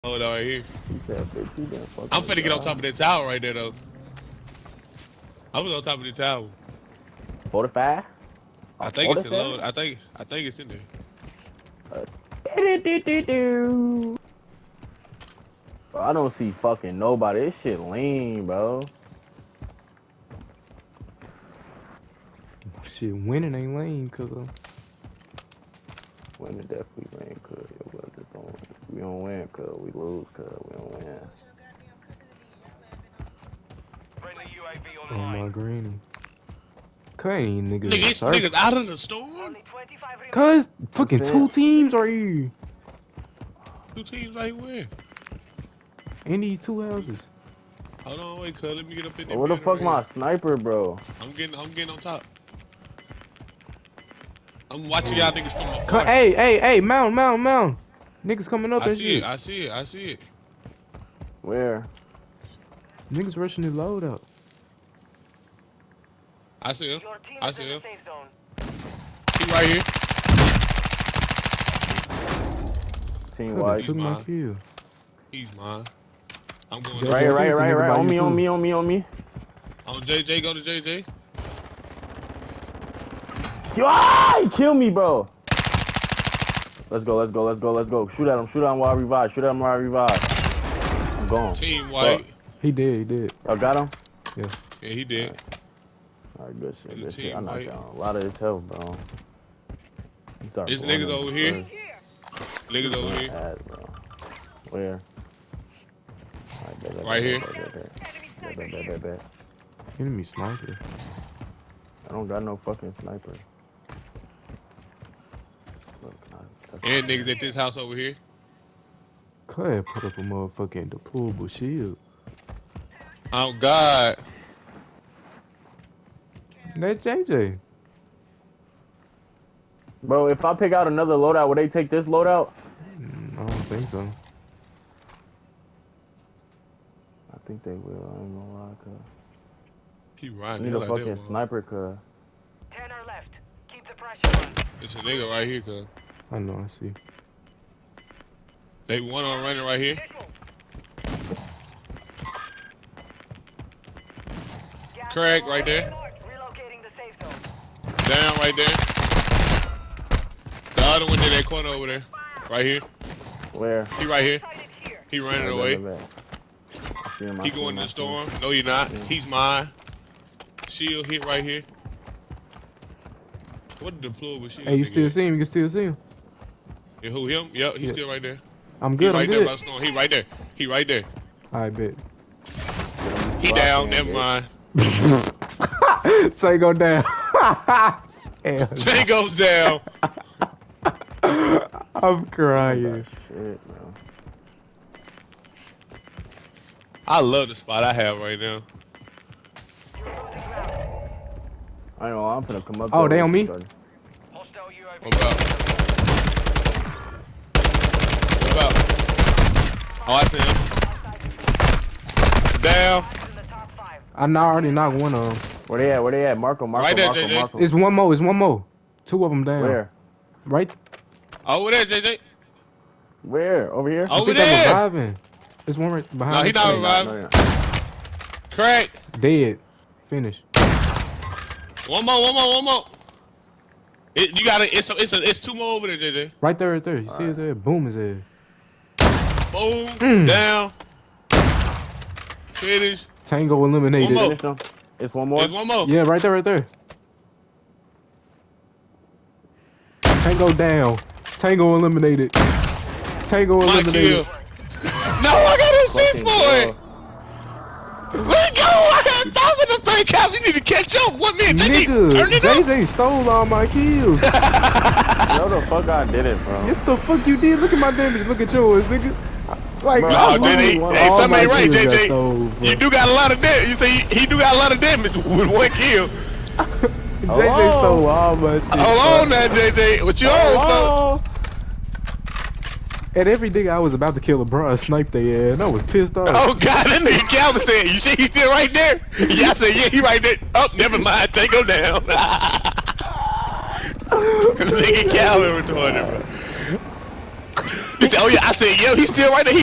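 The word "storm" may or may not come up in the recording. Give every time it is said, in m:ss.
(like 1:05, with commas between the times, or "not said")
0:38, 2:47, 2:59.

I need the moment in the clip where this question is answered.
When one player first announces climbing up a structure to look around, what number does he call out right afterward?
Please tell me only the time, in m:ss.
0:07.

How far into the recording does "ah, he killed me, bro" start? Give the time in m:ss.
1:23.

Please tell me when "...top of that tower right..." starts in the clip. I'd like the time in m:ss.
0:02.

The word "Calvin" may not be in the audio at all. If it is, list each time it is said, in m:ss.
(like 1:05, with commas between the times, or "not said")
4:47, 4:55.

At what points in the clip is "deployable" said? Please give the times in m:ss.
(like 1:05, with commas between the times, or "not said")
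2:00, 2:53.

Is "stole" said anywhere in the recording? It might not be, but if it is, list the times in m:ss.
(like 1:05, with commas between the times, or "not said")
4:22, 4:37.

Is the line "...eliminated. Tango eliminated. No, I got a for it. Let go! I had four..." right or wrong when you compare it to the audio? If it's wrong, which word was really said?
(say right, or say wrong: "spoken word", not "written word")
wrong: "five", not "four".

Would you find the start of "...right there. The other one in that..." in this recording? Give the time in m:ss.
2:38.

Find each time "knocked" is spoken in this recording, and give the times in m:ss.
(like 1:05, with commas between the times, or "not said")
1:37, 3:34.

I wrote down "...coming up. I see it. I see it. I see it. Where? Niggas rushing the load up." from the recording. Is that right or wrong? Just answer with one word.
right.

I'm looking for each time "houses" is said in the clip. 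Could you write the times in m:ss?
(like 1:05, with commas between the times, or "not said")
0:46, 1:57.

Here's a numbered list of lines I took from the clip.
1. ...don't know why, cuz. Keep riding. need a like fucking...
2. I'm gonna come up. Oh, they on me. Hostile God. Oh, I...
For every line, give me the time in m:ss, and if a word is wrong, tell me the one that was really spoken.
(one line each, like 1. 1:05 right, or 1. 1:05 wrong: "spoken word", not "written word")
1. 2:18 right
2. 3:22 wrong: "UAV", not "God".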